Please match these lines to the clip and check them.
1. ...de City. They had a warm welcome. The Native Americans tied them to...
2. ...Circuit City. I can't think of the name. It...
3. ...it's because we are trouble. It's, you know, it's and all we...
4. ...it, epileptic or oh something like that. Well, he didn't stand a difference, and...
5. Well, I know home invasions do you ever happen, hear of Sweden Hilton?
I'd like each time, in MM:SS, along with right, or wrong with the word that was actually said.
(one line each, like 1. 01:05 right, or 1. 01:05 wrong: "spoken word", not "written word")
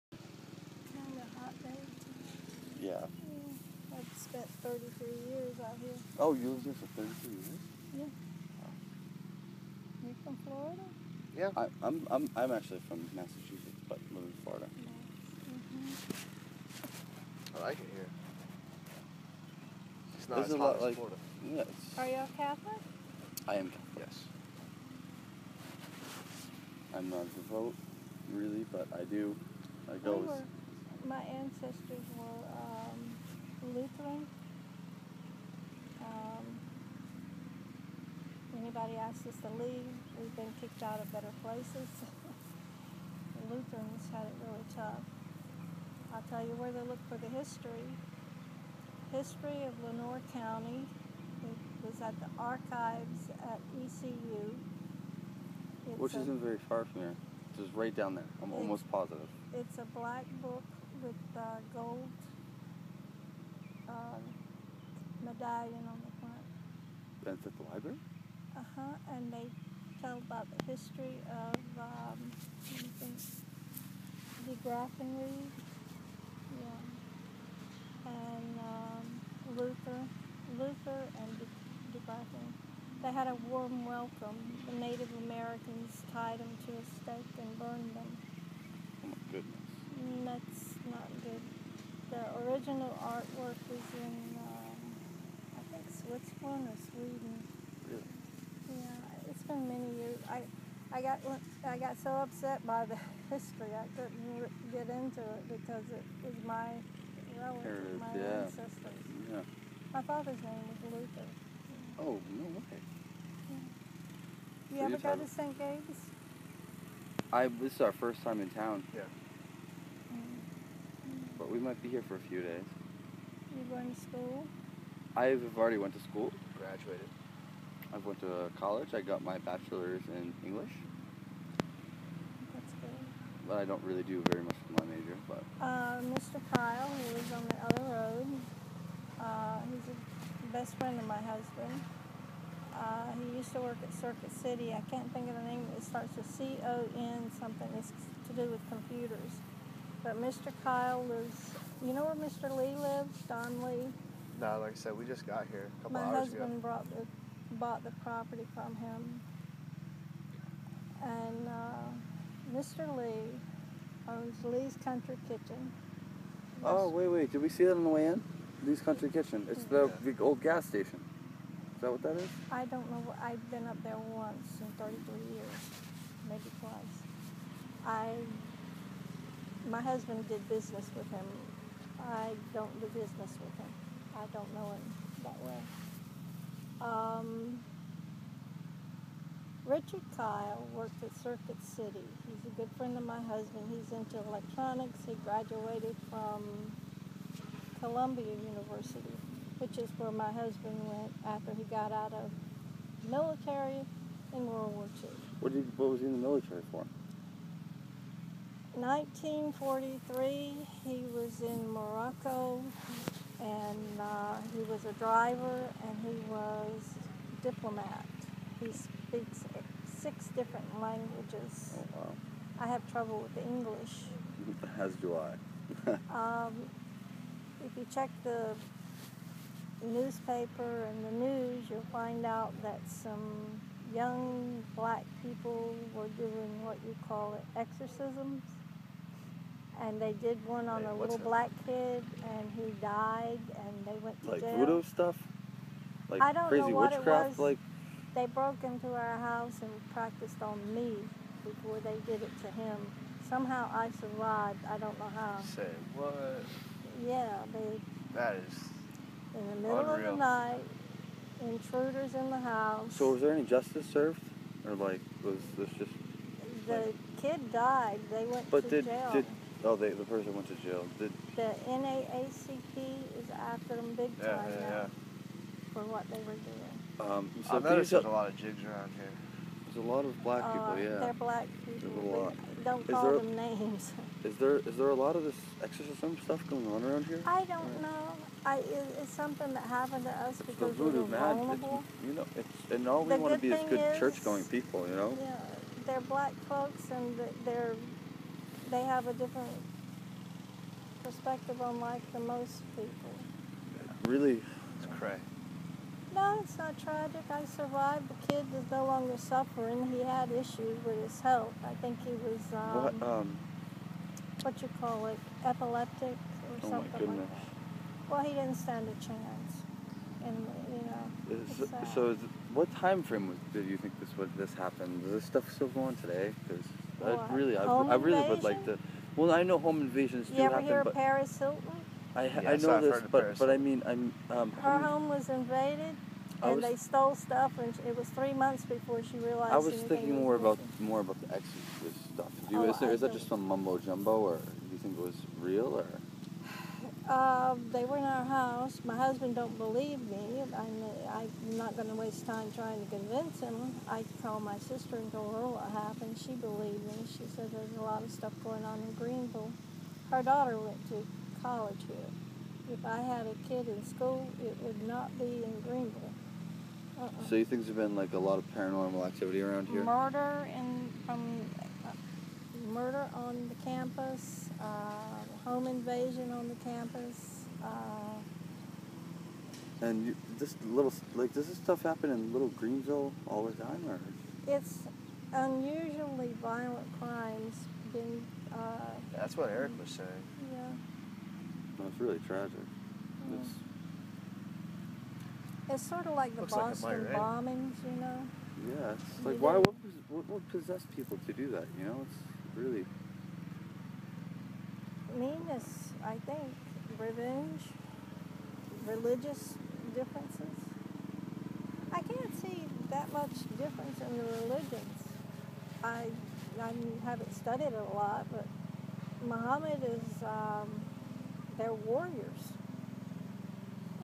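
1. 01:21 wrong: "Graffin", not "City"
2. 02:23 right
3. 04:50 wrong: "vulnerable", not "trouble"
4. 05:15 wrong: "chance", not "difference"
5. 05:29 wrong: "Paris", not "Sweden".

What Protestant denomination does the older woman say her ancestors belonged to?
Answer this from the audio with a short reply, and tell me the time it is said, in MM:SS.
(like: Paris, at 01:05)
Lutheran, at 00:33.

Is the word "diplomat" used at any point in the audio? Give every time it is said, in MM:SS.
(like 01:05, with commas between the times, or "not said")
03:37.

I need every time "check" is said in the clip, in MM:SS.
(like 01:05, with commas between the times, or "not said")
03:47.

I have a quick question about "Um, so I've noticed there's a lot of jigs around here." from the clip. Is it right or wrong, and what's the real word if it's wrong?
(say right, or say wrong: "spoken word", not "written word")
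right.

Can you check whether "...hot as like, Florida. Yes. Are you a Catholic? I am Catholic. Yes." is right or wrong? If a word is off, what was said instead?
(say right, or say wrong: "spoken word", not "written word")
right.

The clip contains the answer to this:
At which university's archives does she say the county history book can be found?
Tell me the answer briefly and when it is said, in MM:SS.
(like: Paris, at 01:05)
ECU, at 00:53.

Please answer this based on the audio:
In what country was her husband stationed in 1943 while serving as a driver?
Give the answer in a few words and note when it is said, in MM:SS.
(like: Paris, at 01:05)
Morocco, at 03:31.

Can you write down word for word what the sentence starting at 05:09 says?
He had issues with his health.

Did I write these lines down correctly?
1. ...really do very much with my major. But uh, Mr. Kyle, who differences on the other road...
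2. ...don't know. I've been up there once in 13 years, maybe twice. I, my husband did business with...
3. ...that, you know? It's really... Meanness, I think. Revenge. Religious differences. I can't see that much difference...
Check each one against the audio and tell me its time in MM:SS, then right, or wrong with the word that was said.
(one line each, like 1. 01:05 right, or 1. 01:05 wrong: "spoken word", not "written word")
1. 02:13 wrong: "lives", not "differences"
2. 02:52 wrong: "33", not "13"
3. 06:41 right.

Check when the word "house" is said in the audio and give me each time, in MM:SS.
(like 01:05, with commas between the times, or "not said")
04:09, 04:22, 05:48.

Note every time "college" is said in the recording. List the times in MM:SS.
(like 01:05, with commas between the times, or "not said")
02:08, 06:01.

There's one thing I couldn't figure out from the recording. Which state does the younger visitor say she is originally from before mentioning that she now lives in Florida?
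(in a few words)
Massachusetts.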